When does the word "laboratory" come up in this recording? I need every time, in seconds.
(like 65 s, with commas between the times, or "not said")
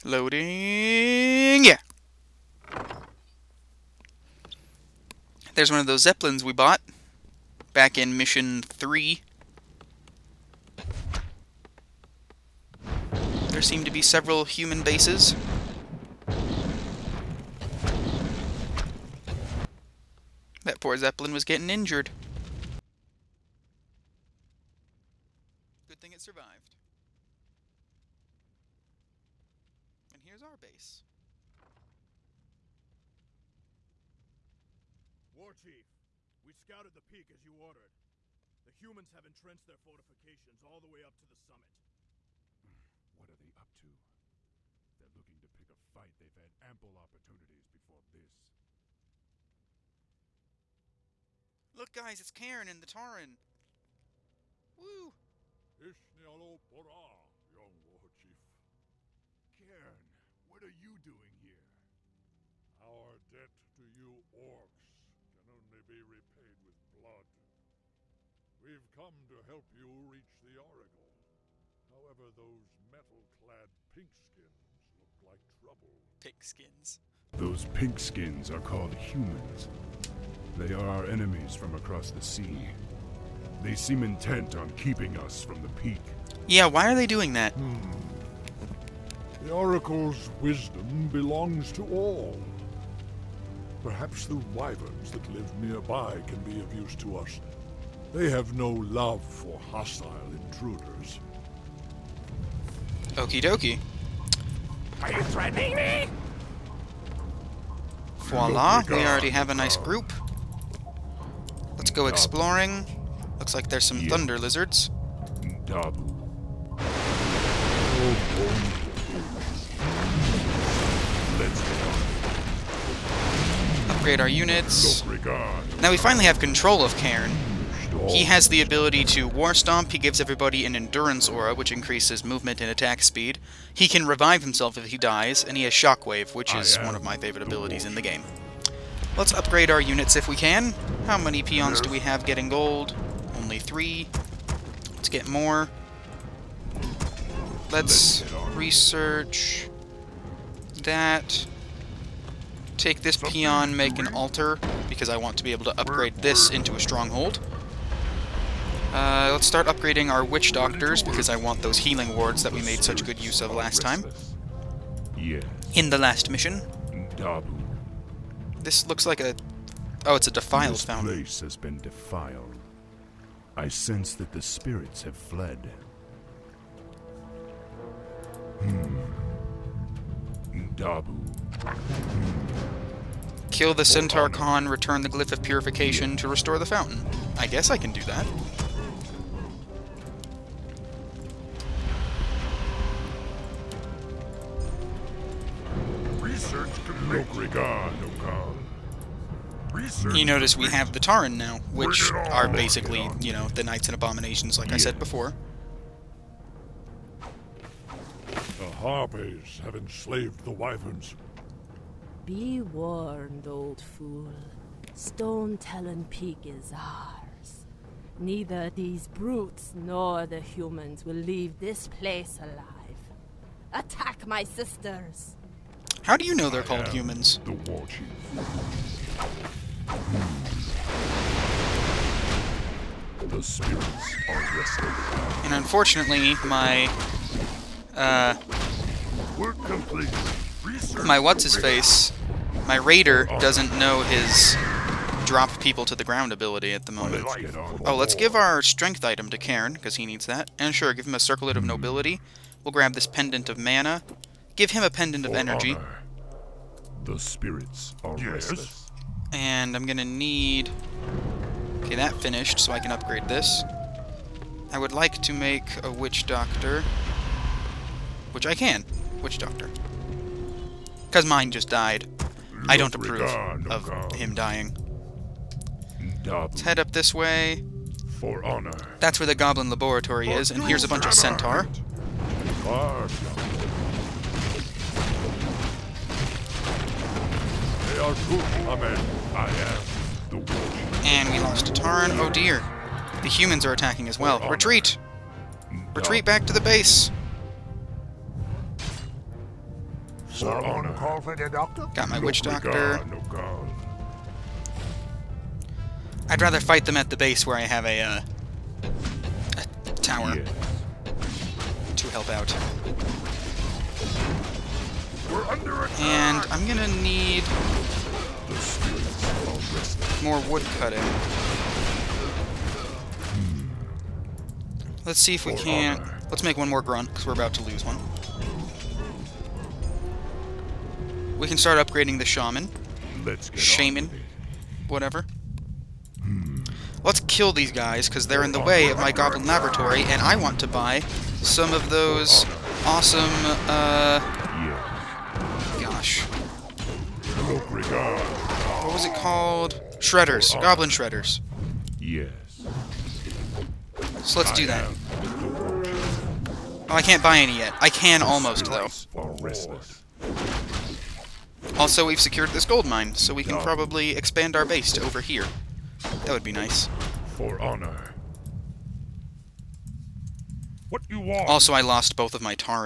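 279 s, 339 s.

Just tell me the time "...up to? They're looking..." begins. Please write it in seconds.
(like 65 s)
43 s.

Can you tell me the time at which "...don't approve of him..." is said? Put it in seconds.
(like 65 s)
272 s.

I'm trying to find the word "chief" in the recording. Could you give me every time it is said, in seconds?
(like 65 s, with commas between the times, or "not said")
35 s, 58 s, 227 s.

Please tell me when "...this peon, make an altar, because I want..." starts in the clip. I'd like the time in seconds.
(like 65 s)
153 s.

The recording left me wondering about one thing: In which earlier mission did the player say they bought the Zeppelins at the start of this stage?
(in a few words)
Mission 3.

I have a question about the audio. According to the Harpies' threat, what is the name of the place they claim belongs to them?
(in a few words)
Stone Talon Peak.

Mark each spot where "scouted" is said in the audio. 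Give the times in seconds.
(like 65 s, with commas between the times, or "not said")
36 s.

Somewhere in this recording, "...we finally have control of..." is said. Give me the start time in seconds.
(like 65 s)
125 s.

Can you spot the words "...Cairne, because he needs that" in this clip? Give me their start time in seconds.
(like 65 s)
249 s.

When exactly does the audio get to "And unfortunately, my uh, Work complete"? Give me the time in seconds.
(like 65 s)
235 s.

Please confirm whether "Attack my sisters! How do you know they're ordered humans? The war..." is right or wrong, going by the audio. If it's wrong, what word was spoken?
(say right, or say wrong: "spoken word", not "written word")
wrong: "called", not "ordered".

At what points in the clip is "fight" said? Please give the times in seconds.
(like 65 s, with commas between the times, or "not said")
45 s, 306 s.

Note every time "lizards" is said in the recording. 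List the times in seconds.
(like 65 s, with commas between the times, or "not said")
114 s.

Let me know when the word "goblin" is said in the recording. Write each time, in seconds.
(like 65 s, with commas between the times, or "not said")
279 s, 339 s, 350 s.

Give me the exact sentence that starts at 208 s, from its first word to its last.
The Harpies have enslaved the Wyverns.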